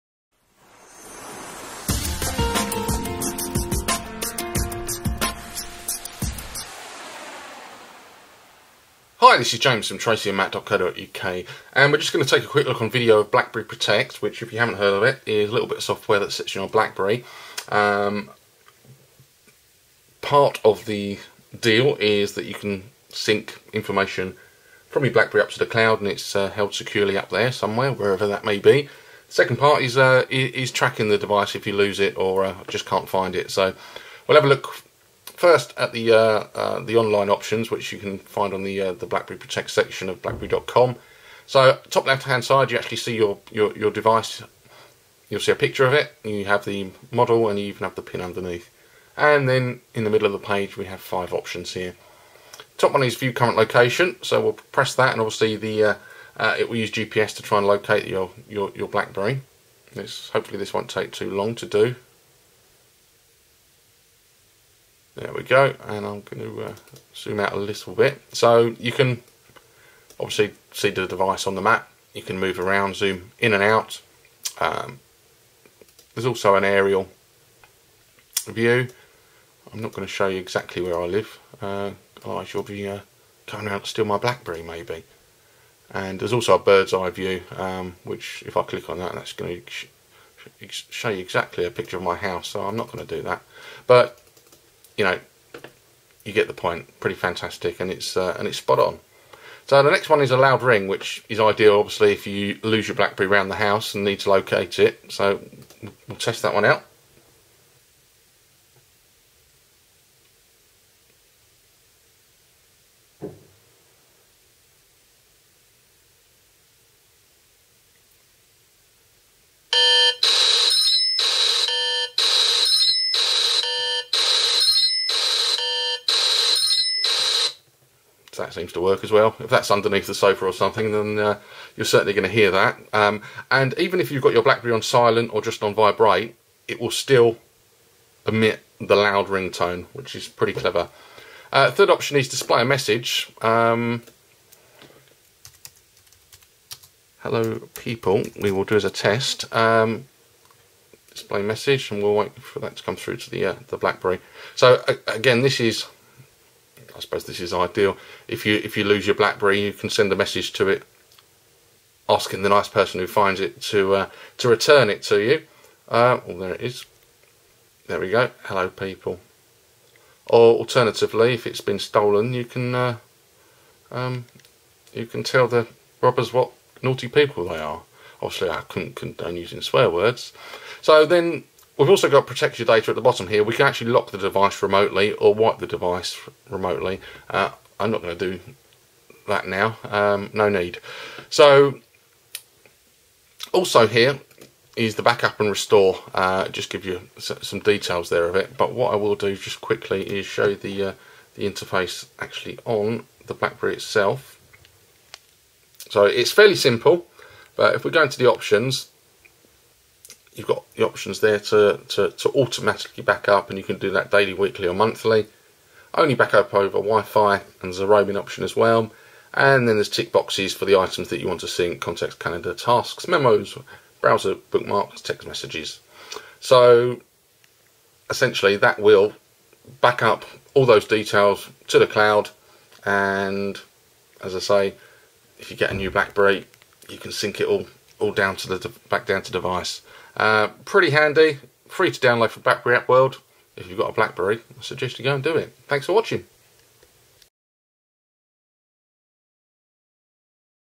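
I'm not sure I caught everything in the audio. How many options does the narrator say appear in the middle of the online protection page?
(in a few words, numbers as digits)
5.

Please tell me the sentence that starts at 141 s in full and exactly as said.
Uh, third option is display a message.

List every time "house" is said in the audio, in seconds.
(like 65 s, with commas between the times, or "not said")
92 s, 103 s.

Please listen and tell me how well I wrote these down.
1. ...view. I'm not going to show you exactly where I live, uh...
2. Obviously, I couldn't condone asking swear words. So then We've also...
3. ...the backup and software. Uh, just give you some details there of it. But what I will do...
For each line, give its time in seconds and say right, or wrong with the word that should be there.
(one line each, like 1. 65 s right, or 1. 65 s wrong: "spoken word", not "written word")
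1. 78 s right
2. 178 s wrong: "using", not "asking"
3. 194 s wrong: "restore", not "software".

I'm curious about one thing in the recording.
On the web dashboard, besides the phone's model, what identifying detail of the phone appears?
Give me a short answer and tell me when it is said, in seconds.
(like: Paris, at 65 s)
PIN, at 48 s.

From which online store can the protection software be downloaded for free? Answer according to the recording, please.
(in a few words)
BlackBerry App World.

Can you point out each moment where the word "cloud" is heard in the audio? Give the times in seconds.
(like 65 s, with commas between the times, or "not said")
25 s, 231 s.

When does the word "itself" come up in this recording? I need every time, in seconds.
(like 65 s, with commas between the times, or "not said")
203 s.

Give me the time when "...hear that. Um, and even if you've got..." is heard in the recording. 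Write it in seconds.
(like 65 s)
132 s.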